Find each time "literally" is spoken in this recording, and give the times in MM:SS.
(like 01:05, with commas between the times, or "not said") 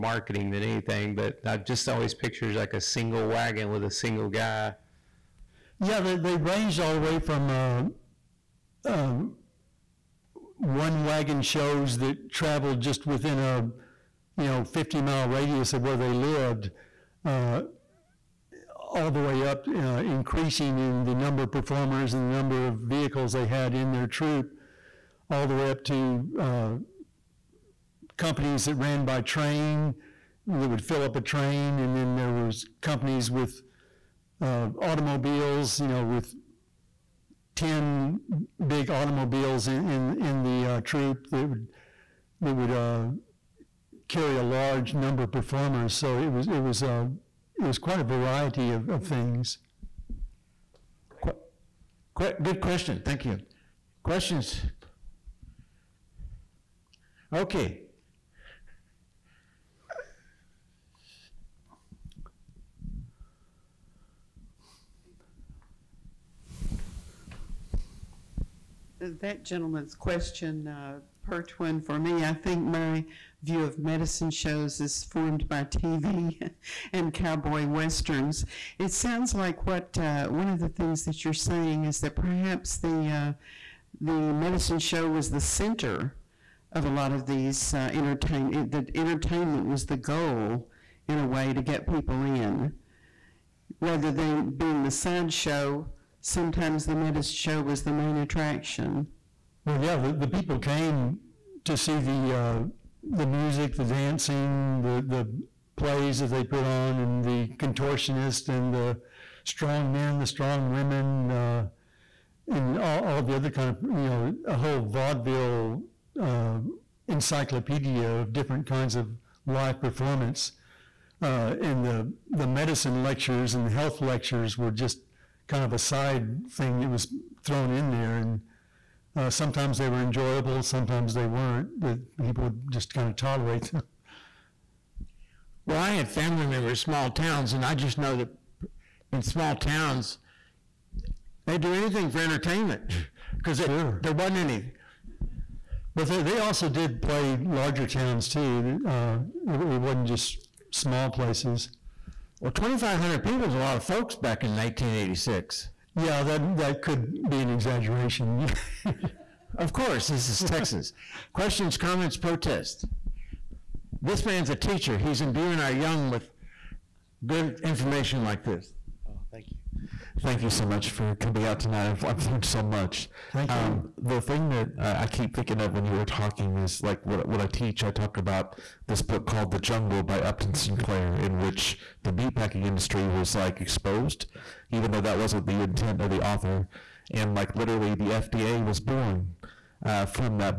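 03:07.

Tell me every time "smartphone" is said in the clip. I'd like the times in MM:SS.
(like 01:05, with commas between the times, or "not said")
not said.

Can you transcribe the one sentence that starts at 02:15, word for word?
Well, I had family members, small towns, and I just know that in small towns, they do anything for entertainment because sure.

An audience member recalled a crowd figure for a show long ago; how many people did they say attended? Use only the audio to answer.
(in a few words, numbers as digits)
2,500.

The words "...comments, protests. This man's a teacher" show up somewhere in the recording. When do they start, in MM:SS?
02:41.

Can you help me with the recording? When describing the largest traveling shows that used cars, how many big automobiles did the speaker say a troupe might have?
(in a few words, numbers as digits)
10.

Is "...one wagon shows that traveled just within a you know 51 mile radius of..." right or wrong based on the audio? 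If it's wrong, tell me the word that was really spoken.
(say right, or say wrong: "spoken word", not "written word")
wrong: "50", not "51".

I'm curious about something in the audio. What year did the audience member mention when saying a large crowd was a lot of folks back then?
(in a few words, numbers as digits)
1986.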